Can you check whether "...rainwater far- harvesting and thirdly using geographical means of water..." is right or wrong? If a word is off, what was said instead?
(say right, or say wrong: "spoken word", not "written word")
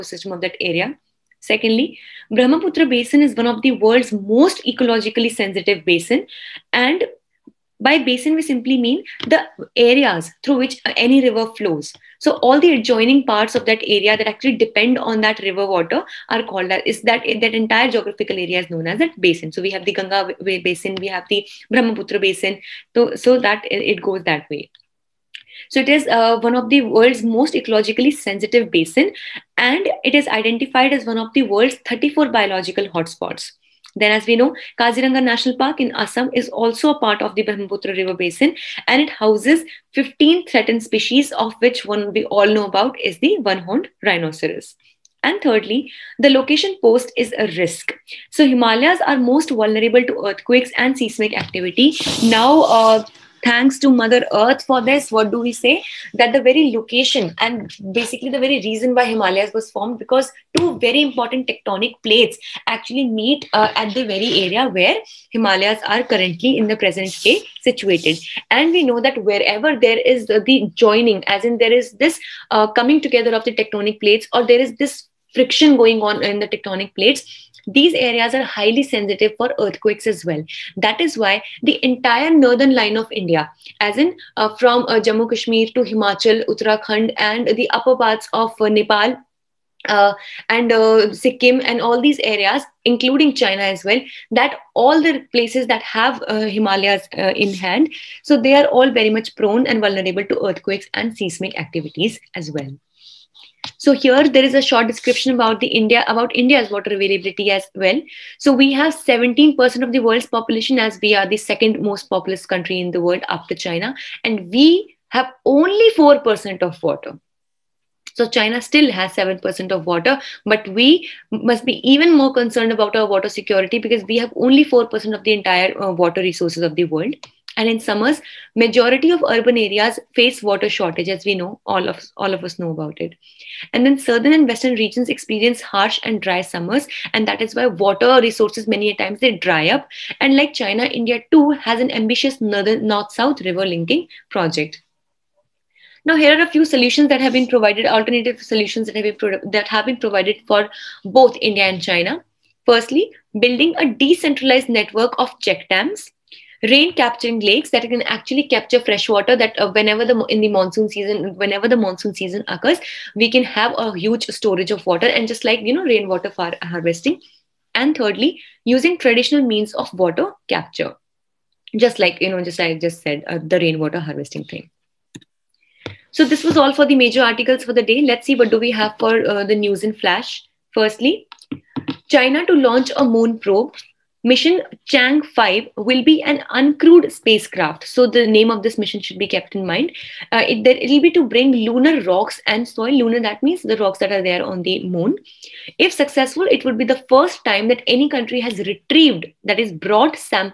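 wrong: "traditional", not "geographical".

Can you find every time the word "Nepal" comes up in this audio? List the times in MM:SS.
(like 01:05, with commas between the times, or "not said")
01:28.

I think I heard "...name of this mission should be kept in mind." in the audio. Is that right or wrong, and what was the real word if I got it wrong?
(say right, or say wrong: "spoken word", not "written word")
right.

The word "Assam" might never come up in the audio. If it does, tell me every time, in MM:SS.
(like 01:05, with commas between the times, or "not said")
00:35.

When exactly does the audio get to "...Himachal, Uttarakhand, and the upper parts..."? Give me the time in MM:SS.
01:25.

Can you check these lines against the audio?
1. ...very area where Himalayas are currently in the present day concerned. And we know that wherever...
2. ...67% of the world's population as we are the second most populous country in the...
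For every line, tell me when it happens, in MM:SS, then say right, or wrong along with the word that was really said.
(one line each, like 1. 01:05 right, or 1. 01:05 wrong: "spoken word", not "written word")
1. 01:04 wrong: "situated", not "concerned"
2. 01:48 wrong: "17", not "67".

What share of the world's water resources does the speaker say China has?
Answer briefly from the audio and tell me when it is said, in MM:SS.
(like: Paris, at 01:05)
7%, at 01:59.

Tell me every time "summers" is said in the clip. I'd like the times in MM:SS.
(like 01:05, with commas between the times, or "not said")
02:07, 02:16.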